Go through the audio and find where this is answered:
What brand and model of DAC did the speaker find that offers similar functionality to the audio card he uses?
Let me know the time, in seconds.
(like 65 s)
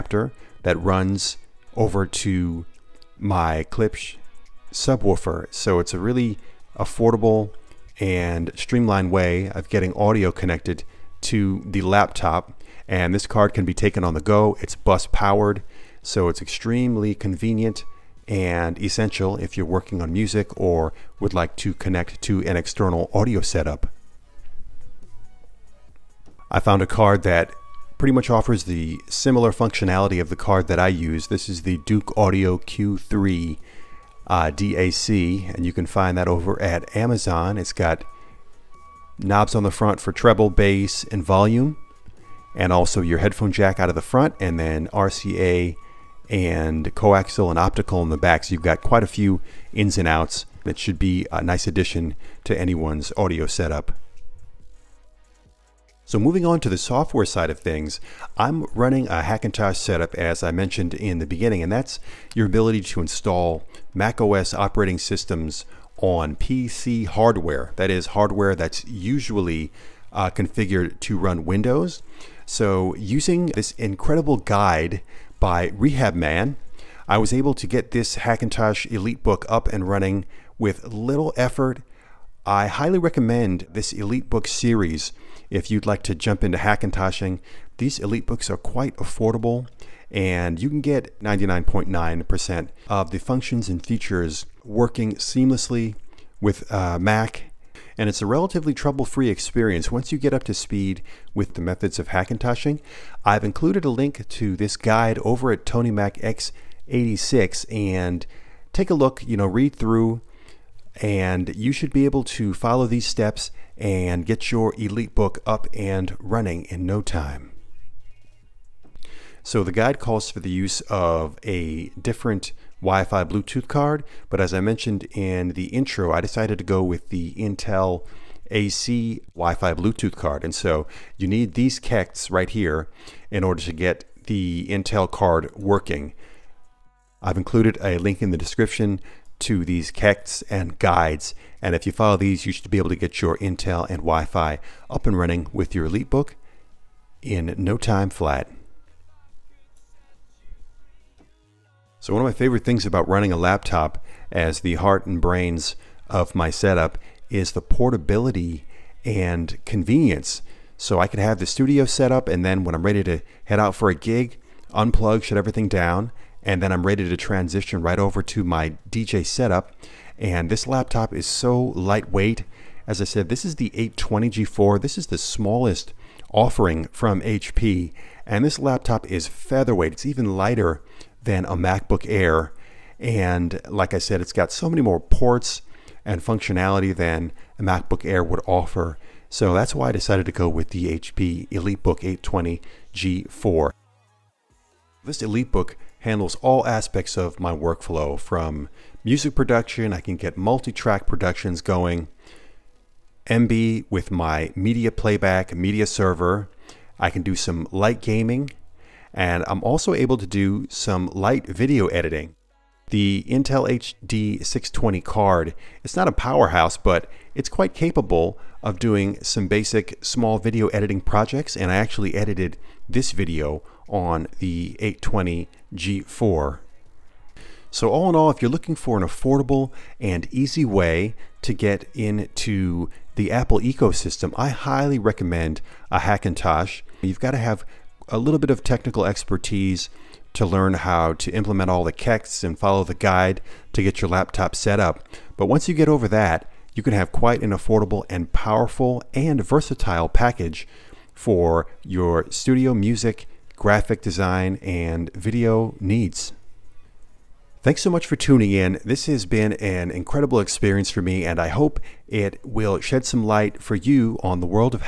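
31 s.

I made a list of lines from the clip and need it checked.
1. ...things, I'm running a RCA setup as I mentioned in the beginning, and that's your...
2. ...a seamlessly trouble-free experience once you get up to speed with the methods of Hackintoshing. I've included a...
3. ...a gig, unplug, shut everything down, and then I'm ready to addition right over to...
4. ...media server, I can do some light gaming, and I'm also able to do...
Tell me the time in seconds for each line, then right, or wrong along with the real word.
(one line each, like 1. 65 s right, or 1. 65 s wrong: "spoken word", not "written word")
1. 57 s wrong: "Hackintosh", not "RCA"
2. 98 s wrong: "relatively", not "seamlessly"
3. 163 s wrong: "transition", not "addition"
4. 205 s right.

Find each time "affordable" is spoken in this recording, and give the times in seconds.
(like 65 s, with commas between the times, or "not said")
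6 s, 88 s, 229 s, 247 s.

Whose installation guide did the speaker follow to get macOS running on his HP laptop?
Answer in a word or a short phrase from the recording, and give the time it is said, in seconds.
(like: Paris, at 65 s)
RehabMan, at 75 s.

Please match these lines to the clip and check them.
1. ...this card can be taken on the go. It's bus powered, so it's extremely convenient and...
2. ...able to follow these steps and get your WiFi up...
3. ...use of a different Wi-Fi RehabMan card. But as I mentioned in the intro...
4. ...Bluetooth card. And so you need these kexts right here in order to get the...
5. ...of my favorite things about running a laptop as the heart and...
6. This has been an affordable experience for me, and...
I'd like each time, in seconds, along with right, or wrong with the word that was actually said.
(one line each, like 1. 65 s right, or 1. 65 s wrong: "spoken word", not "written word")
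1. 13 s right
2. 112 s wrong: "EliteBook", not "WiFi"
3. 120 s wrong: "Bluetooth", not "RehabMan"
4. 129 s right
5. 152 s right
6. 258 s wrong: "incredible", not "affordable".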